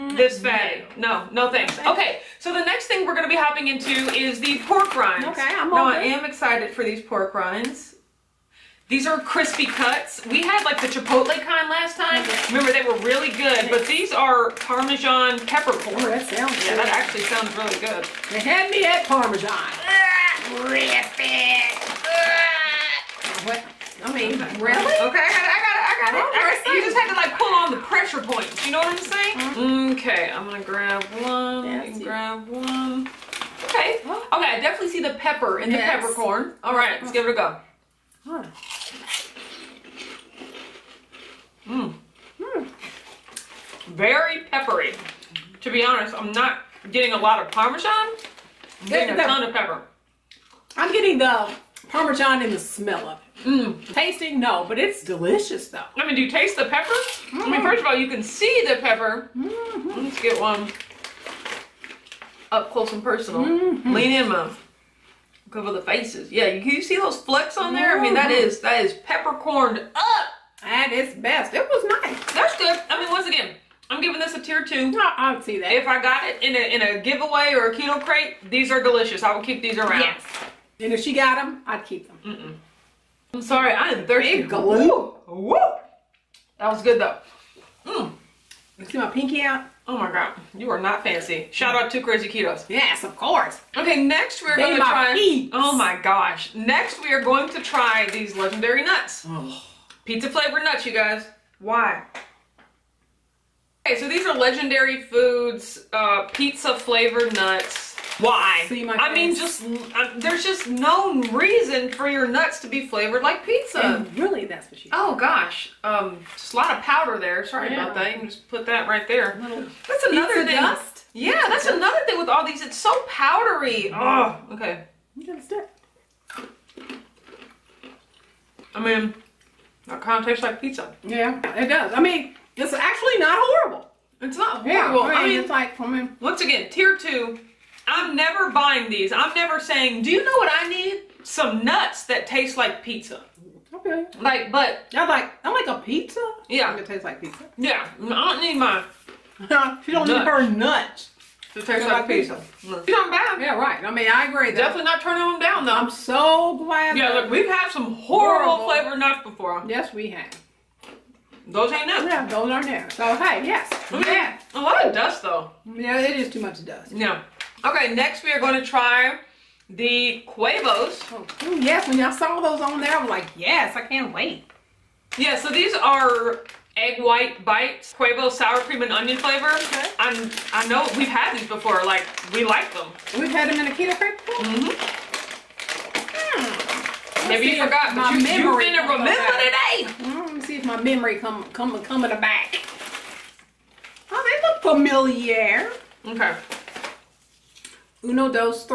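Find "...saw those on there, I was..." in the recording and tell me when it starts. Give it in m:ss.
2:52.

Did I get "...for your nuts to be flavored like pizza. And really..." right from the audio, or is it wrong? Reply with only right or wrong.
right.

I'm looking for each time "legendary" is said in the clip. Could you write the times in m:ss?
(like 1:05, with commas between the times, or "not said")
1:38, 1:44.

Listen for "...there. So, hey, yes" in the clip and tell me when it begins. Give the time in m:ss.
2:42.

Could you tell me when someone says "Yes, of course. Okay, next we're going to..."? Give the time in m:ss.
1:32.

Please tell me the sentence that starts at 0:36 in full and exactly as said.
All right, let's give it a go.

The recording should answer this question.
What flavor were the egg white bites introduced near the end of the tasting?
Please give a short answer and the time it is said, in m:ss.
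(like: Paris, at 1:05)
sour cream and onion, at 2:58.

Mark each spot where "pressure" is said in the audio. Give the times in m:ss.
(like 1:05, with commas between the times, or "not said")
0:27.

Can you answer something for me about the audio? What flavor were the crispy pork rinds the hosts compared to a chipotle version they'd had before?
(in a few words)
Parmesan peppercorn.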